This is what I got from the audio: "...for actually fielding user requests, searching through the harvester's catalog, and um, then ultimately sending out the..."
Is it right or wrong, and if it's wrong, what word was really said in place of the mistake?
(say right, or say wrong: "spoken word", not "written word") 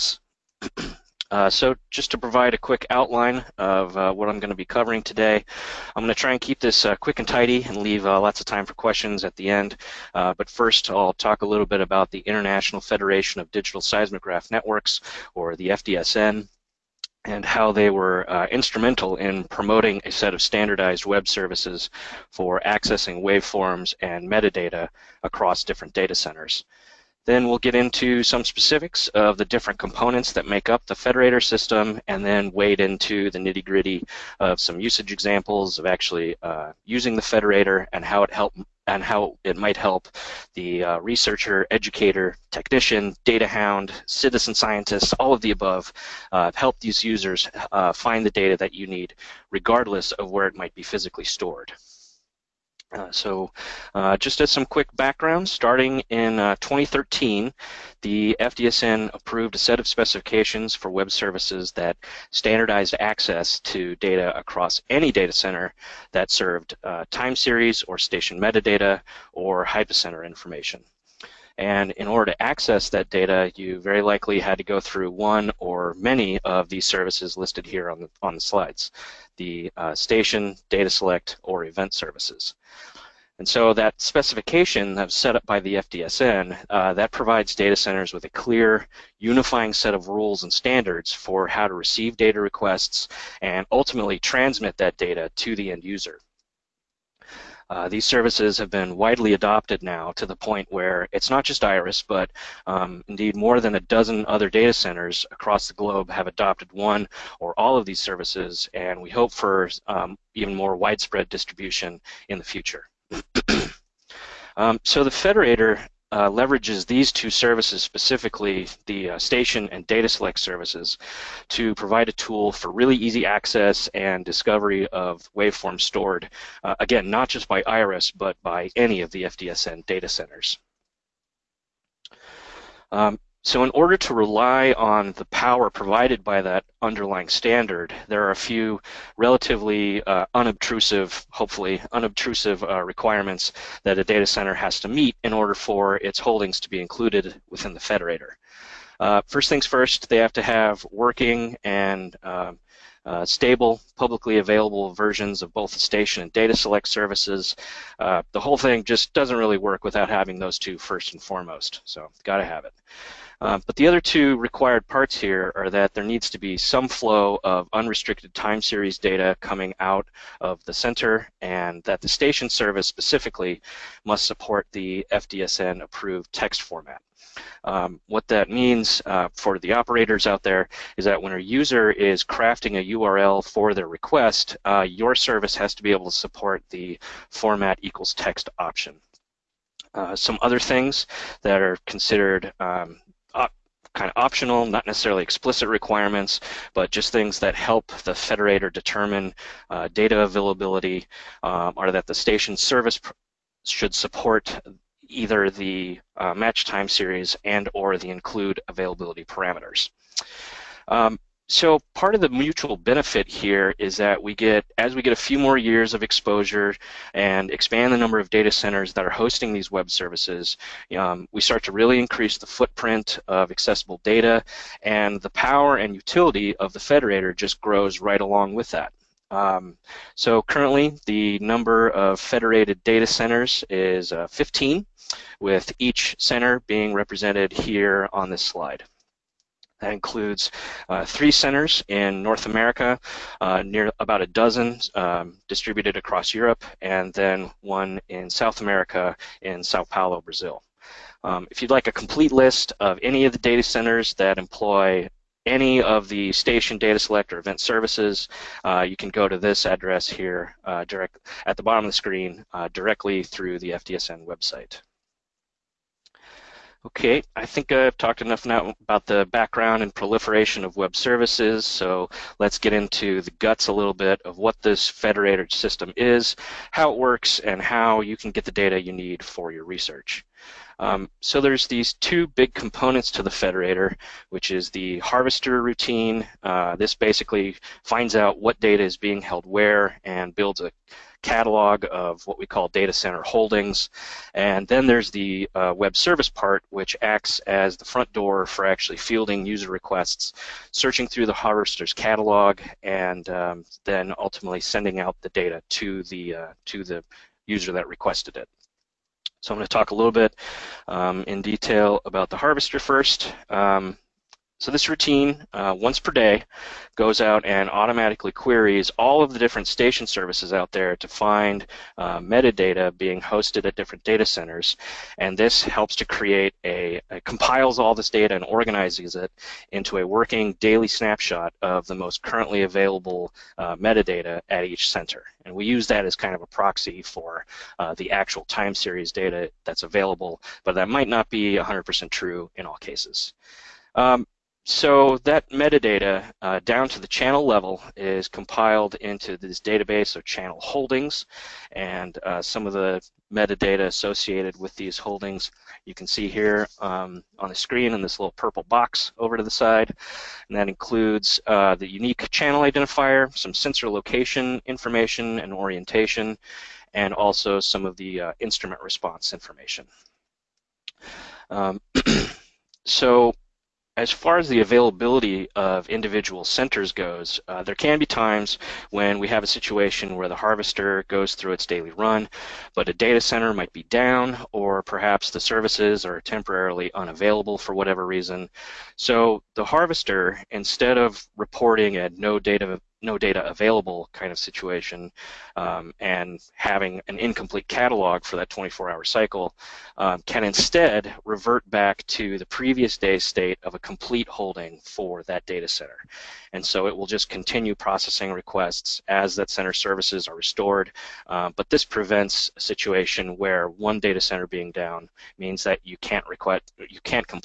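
right.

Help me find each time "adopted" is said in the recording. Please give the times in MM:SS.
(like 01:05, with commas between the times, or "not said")
01:39, 01:46.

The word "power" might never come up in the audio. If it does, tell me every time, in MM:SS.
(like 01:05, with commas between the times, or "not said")
02:15, 03:45.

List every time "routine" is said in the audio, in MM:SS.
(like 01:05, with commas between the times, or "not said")
04:45, 05:14.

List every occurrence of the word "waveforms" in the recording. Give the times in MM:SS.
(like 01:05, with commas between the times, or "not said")
00:23, 02:05.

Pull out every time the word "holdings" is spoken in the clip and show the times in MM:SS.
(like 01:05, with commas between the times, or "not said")
02:26, 04:53, 05:50, 05:54, 06:44.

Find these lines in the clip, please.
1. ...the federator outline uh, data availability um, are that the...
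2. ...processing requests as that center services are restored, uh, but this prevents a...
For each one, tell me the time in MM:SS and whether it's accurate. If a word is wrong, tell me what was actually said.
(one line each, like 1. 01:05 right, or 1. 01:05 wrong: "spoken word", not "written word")
1. 03:18 wrong: "determine", not "outline"
2. 06:47 right.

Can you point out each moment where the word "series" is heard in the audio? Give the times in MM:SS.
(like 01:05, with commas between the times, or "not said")
01:07, 02:48, 03:26, 05:38.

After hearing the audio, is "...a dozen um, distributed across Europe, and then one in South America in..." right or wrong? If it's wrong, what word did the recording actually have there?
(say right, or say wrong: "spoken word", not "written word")
right.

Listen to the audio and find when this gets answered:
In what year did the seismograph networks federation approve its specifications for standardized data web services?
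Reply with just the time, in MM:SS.
00:56.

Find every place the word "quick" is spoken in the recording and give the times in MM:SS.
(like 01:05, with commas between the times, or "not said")
00:02, 00:06, 00:54.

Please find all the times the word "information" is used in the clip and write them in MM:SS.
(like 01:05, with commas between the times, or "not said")
01:10, 06:04, 06:09.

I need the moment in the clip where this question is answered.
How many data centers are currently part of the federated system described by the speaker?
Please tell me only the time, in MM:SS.
03:54.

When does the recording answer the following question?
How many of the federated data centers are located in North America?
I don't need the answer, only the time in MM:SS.
04:01.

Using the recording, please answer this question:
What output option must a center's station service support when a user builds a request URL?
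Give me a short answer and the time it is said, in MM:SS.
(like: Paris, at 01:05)
format equals text, at 03:07.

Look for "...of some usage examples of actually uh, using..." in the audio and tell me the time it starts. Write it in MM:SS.
00:34.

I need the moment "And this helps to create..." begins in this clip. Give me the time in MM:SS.
05:25.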